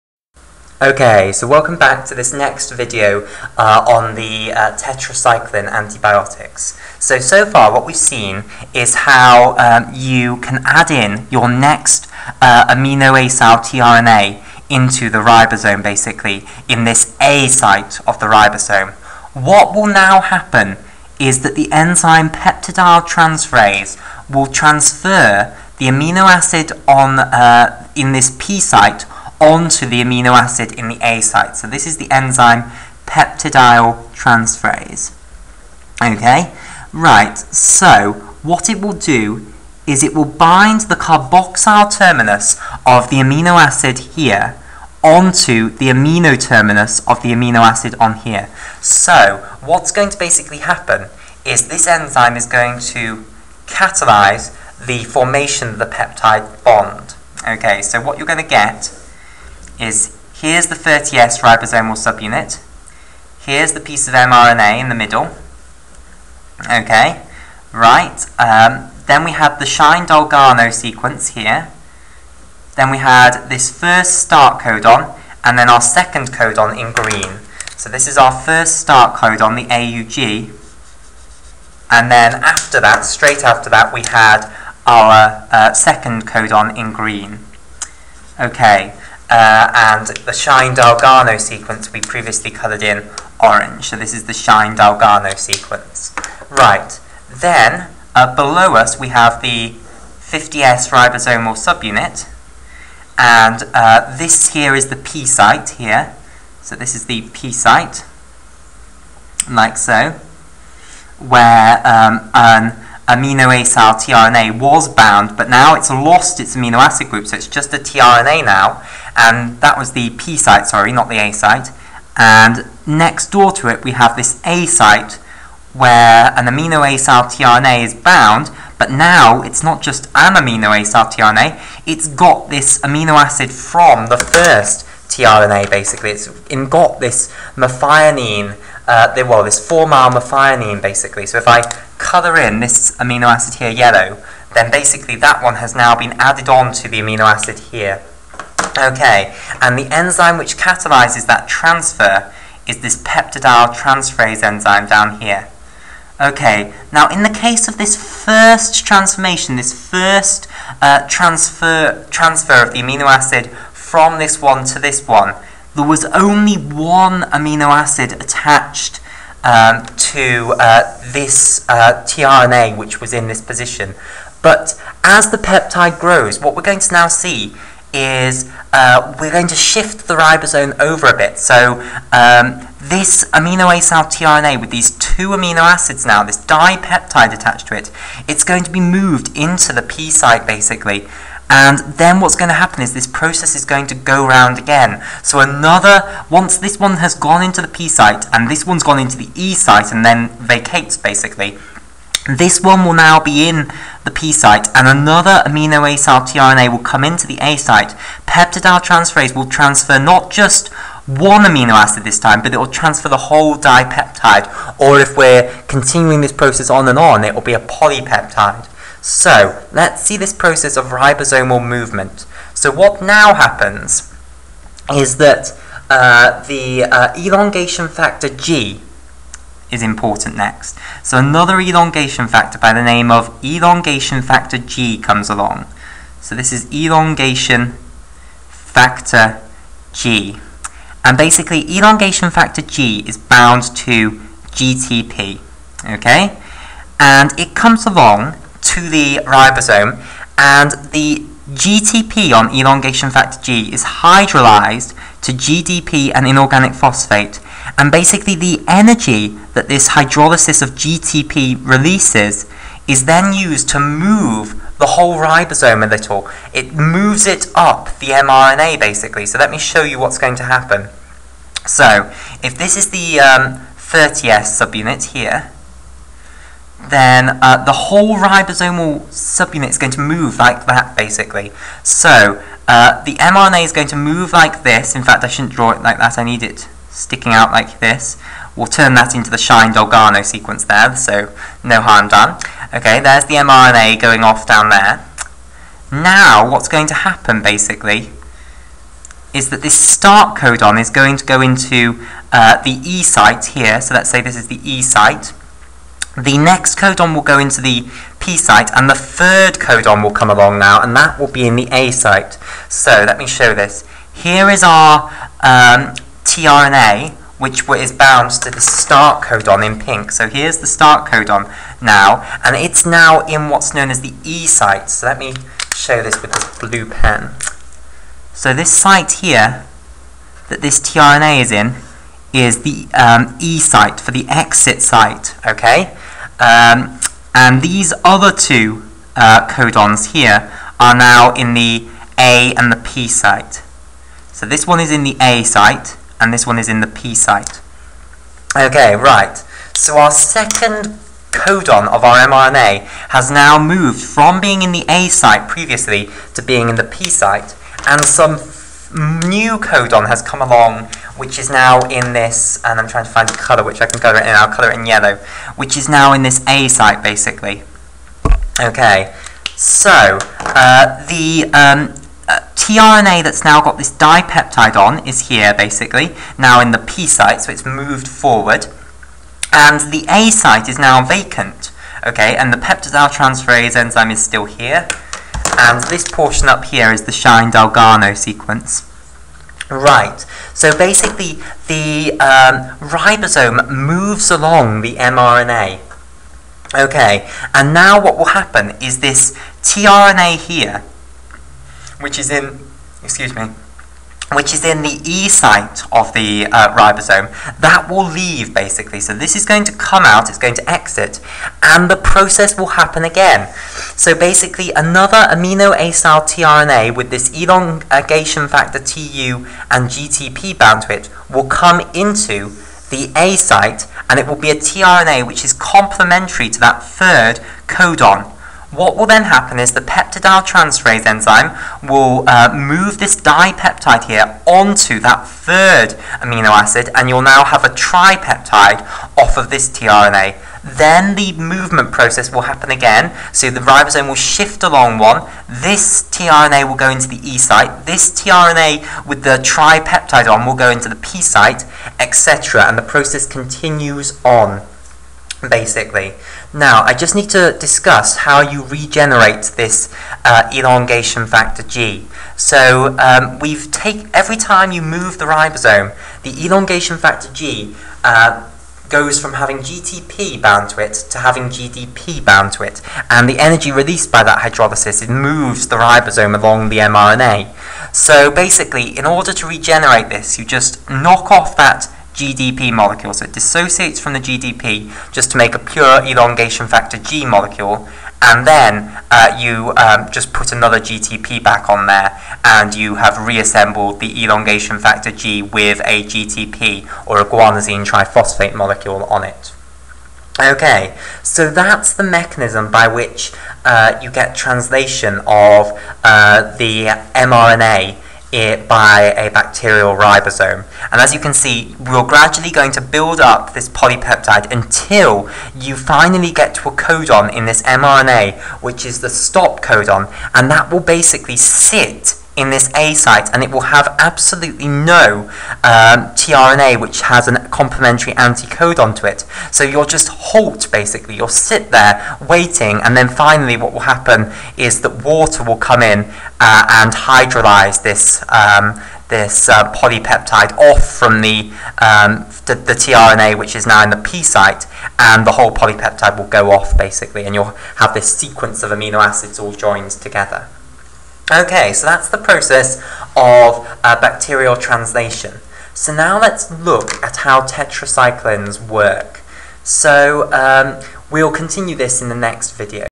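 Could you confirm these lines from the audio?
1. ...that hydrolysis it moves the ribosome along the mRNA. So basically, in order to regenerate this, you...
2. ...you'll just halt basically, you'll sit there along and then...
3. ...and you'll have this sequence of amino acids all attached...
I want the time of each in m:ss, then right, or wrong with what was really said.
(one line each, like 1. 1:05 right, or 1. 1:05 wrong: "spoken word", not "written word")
1. 7:54 right
2. 8:49 wrong: "waiting", not "along"
3. 9:07 wrong: "joined", not "attached".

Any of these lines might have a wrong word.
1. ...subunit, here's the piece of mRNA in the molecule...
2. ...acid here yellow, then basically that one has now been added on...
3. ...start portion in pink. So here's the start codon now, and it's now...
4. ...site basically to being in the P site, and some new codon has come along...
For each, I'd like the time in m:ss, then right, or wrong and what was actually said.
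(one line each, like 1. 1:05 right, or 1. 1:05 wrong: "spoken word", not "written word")
1. 1:01 wrong: "middle", not "molecule"
2. 2:23 right
3. 5:18 wrong: "codon", not "portion"
4. 5:55 wrong: "previously", not "basically".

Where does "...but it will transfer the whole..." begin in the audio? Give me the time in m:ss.
3:32.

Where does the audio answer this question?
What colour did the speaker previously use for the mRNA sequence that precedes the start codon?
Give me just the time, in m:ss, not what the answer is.
1:33.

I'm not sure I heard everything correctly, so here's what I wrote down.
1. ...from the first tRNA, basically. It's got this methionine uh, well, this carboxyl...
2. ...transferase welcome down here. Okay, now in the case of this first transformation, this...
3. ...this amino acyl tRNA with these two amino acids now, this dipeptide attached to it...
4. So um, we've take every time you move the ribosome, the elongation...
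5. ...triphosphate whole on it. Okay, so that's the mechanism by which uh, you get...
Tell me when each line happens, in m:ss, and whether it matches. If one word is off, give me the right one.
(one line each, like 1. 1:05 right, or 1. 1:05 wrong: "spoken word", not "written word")
1. 2:13 wrong: "formyl", not "carboxyl"
2. 2:33 wrong: "enzyme", not "welcome"
3. 3:02 right
4. 7:42 right
5. 8:17 wrong: "molecule", not "whole".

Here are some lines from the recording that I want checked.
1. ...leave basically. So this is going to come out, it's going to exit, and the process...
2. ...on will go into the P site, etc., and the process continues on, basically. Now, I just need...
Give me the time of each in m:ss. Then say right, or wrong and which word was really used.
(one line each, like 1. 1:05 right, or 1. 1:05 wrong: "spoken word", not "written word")
1. 6:48 right
2. 7:30 right.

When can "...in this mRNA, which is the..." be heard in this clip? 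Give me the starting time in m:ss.
8:37.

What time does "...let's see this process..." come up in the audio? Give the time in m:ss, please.
3:39.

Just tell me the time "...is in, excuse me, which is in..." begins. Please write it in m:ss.
6:42.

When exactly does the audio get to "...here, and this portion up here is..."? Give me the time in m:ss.
6:24.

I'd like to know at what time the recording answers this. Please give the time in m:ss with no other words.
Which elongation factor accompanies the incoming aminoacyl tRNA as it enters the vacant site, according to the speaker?
6:57.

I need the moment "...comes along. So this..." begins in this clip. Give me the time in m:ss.
3:54.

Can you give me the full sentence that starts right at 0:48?
So what's going to basically happen is this enzyme is going to catalyze the formation of the peptide bond.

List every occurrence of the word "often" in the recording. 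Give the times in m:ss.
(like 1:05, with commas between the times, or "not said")
not said.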